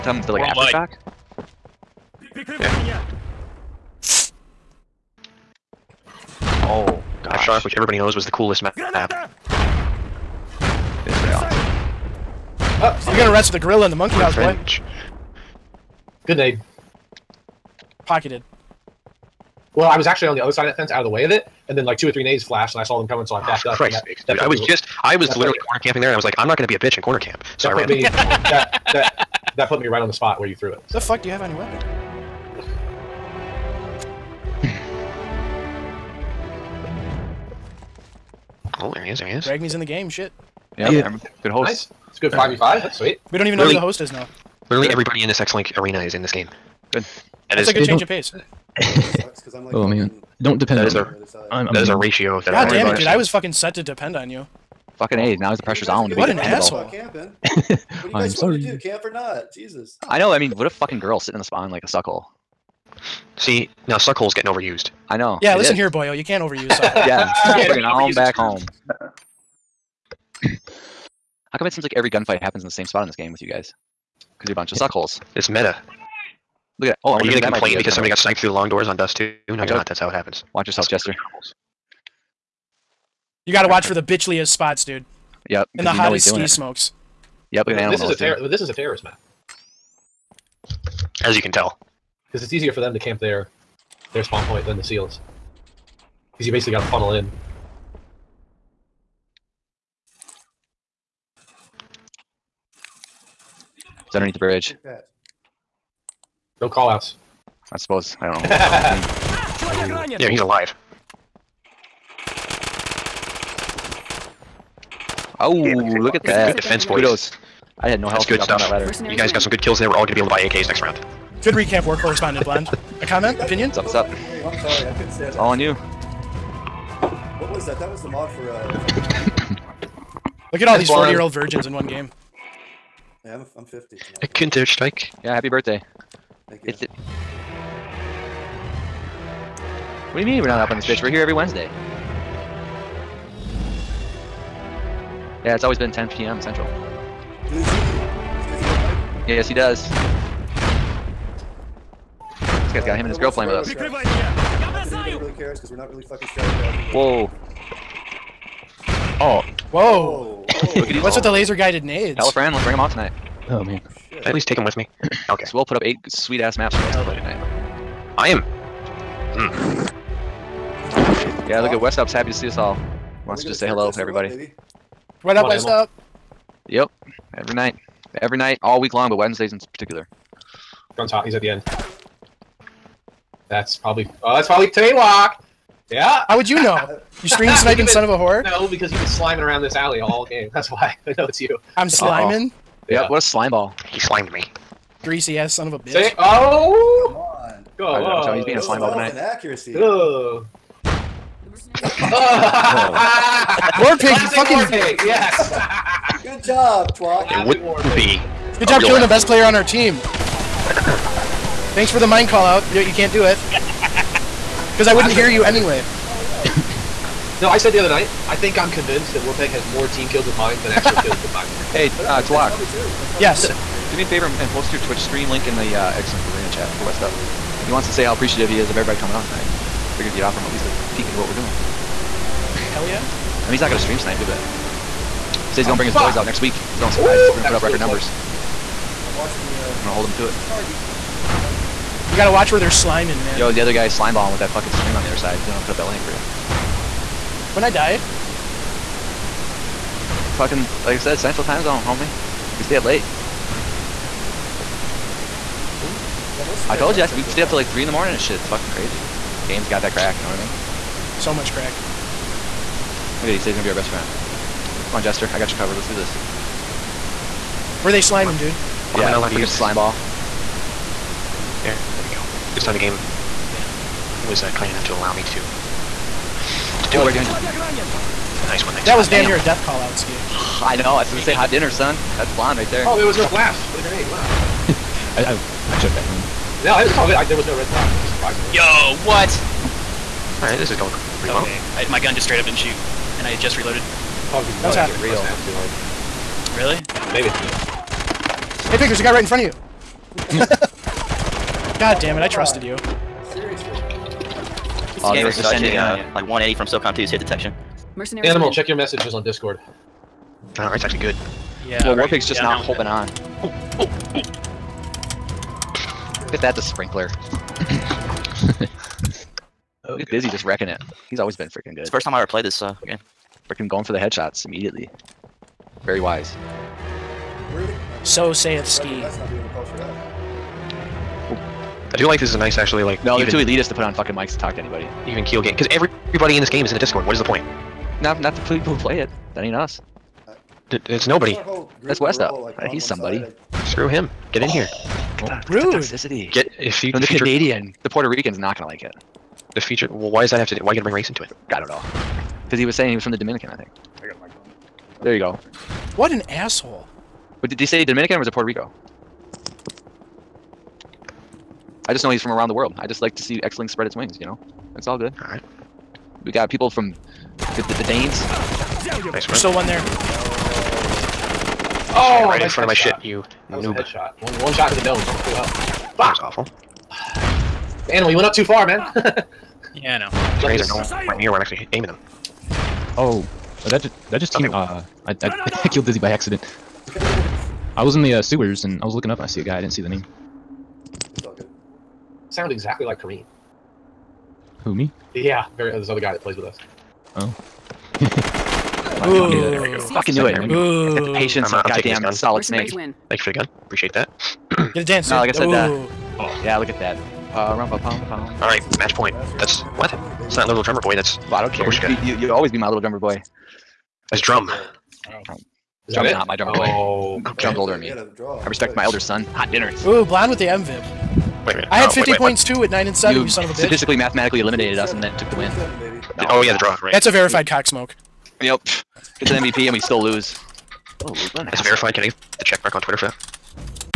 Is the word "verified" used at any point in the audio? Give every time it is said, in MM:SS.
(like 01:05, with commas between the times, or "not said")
07:07, 07:11.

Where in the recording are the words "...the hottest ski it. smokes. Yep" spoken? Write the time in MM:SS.
01:25.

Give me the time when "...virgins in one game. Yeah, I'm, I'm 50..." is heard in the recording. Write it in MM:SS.
02:11.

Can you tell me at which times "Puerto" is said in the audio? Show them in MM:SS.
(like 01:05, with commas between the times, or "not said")
05:47, 05:58.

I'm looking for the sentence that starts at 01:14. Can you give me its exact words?
Because you're a bunch of suckholes.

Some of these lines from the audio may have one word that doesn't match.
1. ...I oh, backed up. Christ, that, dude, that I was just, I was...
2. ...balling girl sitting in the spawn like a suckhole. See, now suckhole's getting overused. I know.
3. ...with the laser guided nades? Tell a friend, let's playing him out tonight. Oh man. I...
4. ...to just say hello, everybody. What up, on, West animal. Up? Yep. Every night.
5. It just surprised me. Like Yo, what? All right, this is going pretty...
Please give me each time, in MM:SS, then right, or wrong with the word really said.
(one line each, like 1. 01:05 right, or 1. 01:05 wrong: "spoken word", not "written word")
1. 00:23 right
2. 01:00 wrong: "fucking", not "balling"
3. 02:41 wrong: "bring", not "playing"
4. 02:53 right
5. 04:48 right.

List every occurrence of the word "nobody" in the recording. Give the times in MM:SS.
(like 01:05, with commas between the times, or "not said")
05:41.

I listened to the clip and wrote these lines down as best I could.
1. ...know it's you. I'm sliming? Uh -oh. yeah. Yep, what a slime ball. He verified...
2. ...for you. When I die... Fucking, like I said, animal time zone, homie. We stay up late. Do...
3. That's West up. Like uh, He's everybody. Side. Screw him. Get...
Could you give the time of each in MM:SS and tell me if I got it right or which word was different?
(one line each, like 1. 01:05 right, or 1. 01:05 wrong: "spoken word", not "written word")
1. 03:11 wrong: "slimed", not "verified"
2. 04:06 wrong: "central", not "animal"
3. 05:41 wrong: "somebody", not "everybody".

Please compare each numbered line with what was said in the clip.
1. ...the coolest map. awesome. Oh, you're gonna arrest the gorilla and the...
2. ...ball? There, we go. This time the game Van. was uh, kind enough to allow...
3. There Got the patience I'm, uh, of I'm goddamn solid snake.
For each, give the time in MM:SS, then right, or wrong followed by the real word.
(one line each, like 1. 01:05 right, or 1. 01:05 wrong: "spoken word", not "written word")
1. 00:08 right
2. 04:29 right
3. 06:40 right.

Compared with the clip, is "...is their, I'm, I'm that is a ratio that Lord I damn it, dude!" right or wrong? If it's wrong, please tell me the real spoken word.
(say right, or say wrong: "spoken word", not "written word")
wrong: "God", not "Lord".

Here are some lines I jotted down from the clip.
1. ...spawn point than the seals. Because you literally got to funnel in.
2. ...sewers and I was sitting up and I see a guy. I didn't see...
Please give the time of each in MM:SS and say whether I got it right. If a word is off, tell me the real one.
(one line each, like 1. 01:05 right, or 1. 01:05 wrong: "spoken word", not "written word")
1. 01:34 wrong: "basically", not "literally"
2. 06:28 wrong: "looking", not "sitting".